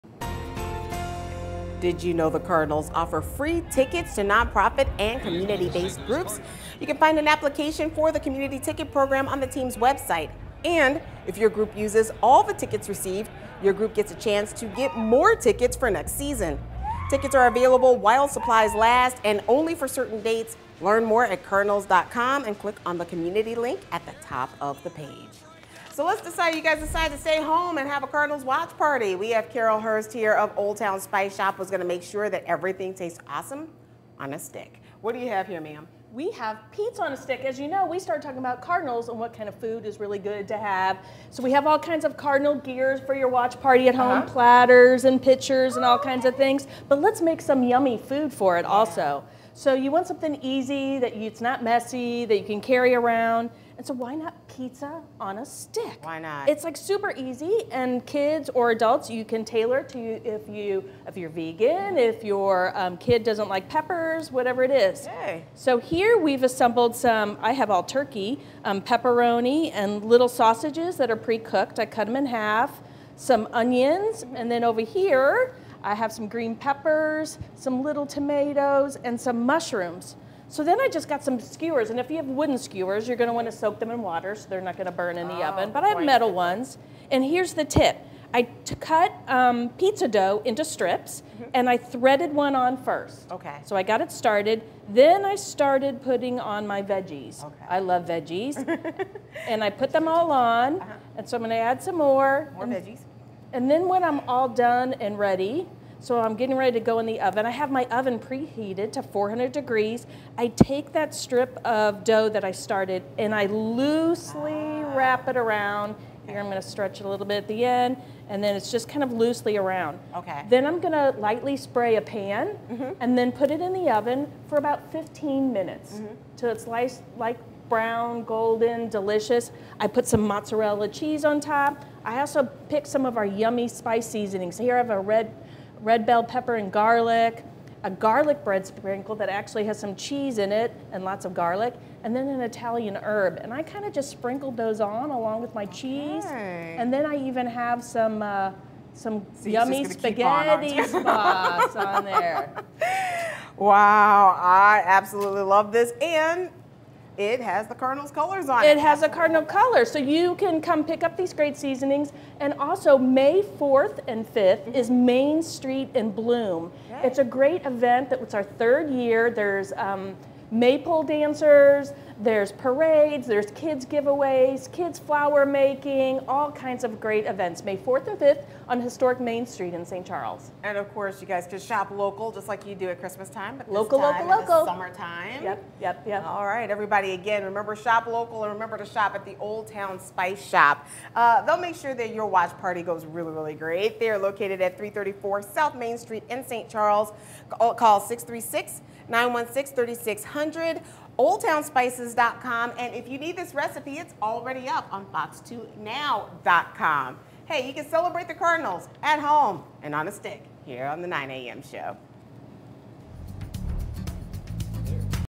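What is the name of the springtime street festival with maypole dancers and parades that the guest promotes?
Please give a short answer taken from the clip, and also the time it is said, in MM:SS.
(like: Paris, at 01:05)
Main Street in Bloom, at 02:45.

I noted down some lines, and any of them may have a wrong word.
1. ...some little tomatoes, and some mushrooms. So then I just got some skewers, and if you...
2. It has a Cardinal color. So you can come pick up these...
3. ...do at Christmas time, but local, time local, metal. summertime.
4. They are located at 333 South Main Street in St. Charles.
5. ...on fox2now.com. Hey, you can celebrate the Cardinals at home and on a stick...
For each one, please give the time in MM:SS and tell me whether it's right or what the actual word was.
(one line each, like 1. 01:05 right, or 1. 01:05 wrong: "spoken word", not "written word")
1. 01:17 right
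2. 02:38 right
3. 03:02 wrong: "local", not "metal"
4. 03:13 wrong: "334", not "333"
5. 03:24 right.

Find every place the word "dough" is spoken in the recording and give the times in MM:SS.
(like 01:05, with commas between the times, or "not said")
01:30, 01:52.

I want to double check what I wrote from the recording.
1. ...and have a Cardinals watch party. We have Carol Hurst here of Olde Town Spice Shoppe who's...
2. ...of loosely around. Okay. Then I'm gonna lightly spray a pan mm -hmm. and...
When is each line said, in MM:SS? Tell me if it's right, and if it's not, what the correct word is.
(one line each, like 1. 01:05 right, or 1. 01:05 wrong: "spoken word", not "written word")
1. 00:27 right
2. 01:59 right.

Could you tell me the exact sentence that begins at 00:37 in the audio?
As you know, we started talking about cardinals and what kind of food is really good to have.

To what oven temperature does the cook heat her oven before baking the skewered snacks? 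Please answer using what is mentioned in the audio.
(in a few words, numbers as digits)
400 degrees.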